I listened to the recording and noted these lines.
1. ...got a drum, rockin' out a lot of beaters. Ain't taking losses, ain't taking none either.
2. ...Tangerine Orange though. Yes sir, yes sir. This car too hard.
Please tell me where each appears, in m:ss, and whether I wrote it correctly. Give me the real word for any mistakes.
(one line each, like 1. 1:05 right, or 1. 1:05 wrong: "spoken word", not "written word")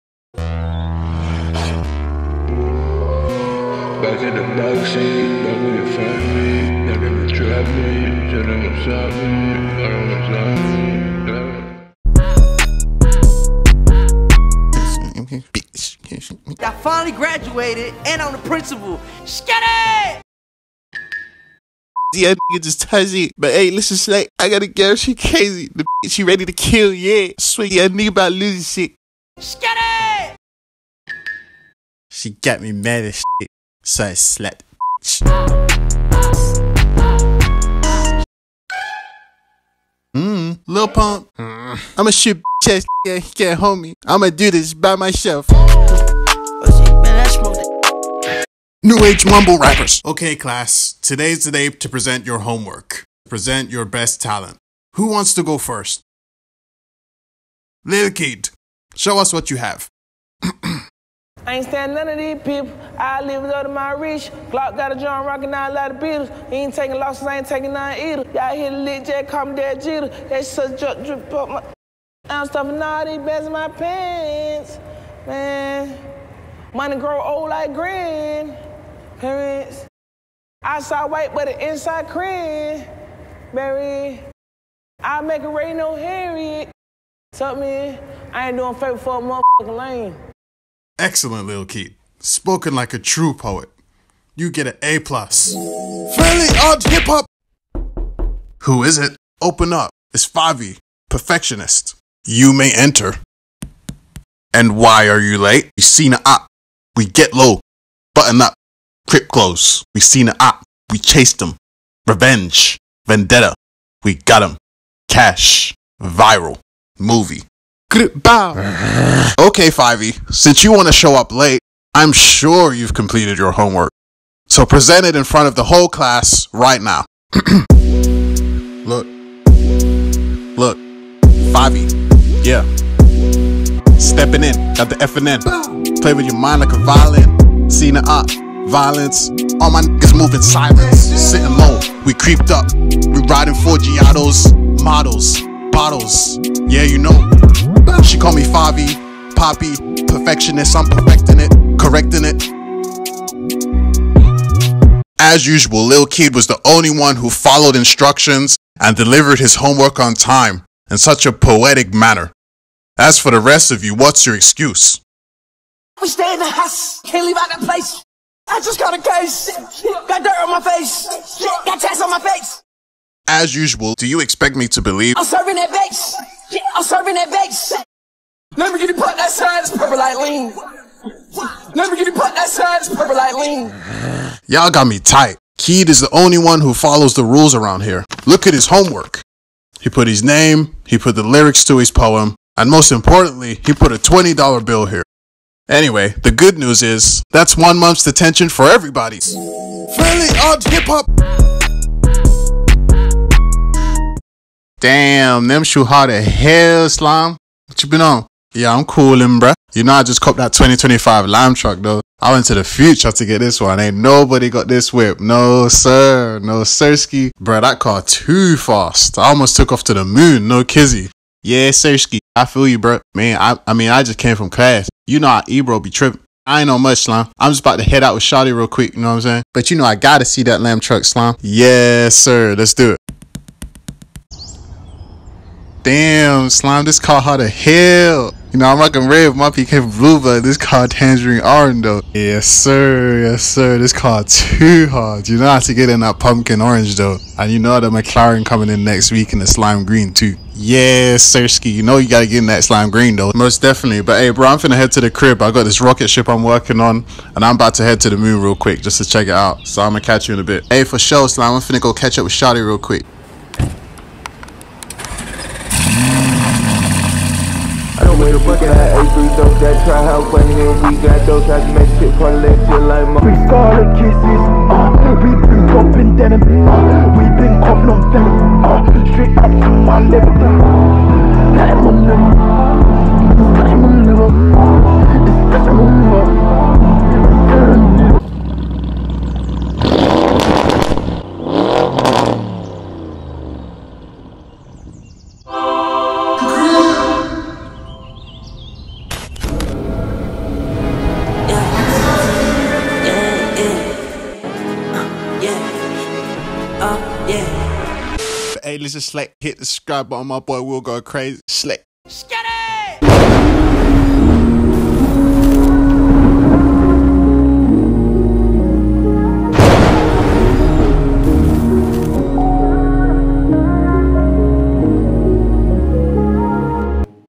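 1. 1:04 right
2. 4:00 right.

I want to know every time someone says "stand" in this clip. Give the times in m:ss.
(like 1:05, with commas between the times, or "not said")
1:01.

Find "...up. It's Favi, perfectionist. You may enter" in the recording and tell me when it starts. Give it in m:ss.
1:39.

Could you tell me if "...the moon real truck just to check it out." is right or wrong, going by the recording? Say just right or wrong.
wrong.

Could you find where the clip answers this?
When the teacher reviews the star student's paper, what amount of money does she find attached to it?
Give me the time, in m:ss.
3:13.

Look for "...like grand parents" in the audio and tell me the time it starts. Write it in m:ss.
1:17.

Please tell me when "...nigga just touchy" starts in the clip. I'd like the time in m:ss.
0:22.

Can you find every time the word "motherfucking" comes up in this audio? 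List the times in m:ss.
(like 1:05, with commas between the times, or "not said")
1:29.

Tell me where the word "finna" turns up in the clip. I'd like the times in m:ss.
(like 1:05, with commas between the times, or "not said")
4:14, 4:21.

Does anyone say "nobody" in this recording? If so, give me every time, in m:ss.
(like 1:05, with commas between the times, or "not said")
3:33.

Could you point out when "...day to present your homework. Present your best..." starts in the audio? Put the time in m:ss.
0:51.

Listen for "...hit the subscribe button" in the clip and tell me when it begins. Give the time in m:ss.
5:09.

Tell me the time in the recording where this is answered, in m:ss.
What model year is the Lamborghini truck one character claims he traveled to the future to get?
3:30.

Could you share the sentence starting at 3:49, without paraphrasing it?
But you know I gotta see that lamb truck slime.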